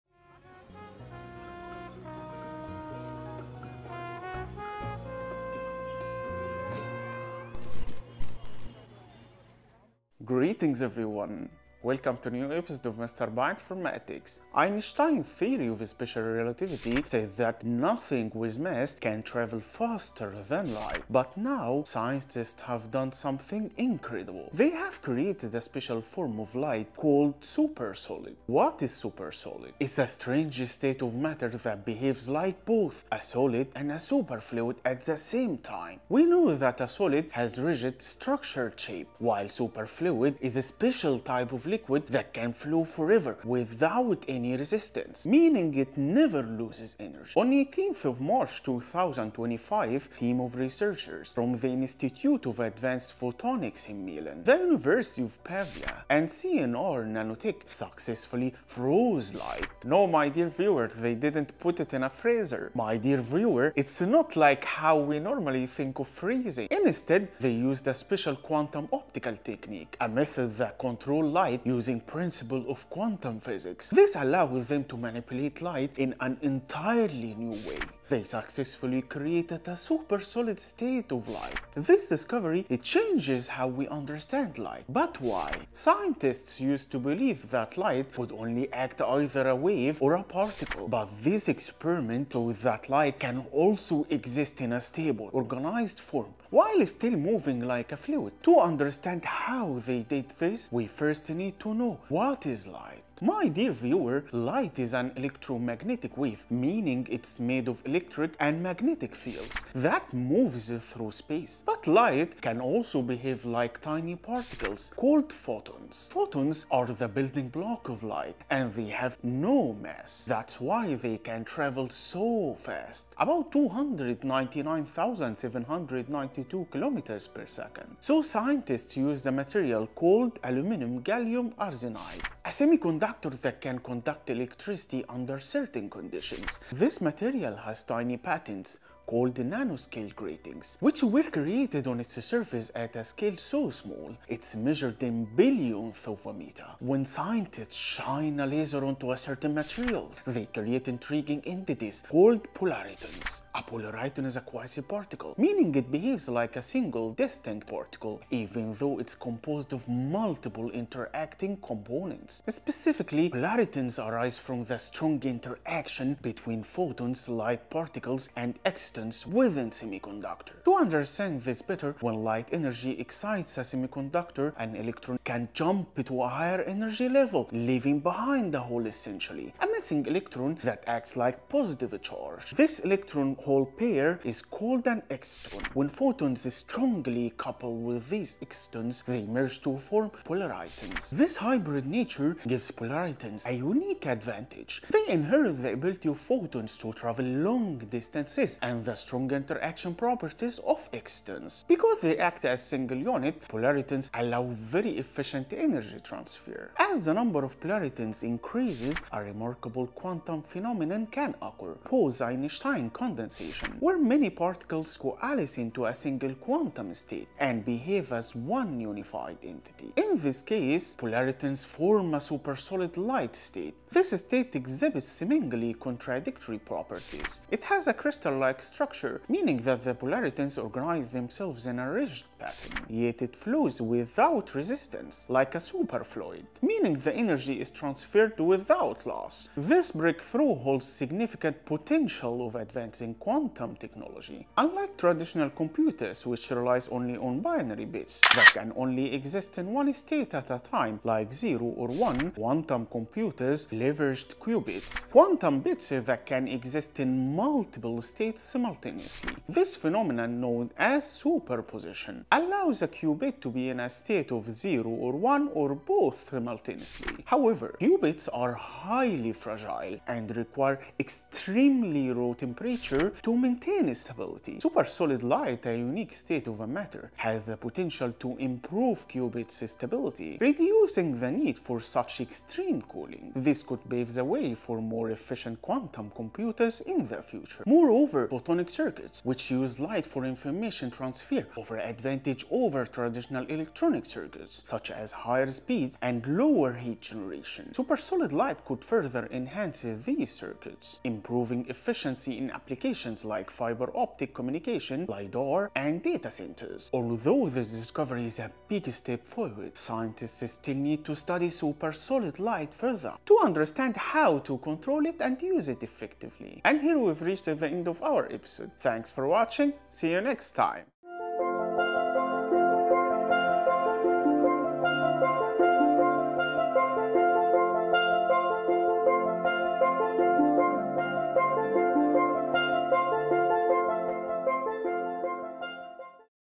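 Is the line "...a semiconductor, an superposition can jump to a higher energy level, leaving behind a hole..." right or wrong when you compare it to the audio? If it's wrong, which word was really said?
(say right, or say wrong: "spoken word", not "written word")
wrong: "electron", not "superposition".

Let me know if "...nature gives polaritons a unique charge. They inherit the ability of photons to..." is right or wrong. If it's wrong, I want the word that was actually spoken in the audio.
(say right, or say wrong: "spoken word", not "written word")
wrong: "advantage", not "charge".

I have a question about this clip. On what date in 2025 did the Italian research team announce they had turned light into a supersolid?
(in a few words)
18 March.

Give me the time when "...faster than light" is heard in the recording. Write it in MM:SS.
00:19.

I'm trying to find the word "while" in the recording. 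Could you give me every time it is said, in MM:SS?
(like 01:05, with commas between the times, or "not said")
00:39, 01:36.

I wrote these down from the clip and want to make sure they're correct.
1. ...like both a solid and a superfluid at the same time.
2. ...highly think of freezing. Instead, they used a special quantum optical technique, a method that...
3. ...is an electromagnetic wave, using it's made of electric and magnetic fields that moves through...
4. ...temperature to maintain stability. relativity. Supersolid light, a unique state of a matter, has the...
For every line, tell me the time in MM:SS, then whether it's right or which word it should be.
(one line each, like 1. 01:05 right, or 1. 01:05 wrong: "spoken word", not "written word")
1. 00:32 right
2. 01:05 wrong: "normally", not "highly"
3. 01:44 wrong: "meaning", not "using"
4. 04:32 wrong: "stability", not "relativity".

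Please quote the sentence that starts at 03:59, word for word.
This breakthrough holds significant potential of advancing quantum technology.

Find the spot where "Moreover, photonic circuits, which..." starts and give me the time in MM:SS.
04:47.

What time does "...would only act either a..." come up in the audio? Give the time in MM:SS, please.
01:28.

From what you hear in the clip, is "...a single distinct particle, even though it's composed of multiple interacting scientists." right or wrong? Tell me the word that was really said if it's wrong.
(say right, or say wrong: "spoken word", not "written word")
wrong: "components", not "scientists".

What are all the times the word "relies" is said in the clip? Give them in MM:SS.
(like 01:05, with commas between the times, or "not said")
04:06.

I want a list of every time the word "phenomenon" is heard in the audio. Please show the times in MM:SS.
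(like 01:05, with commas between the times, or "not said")
03:30, 04:19.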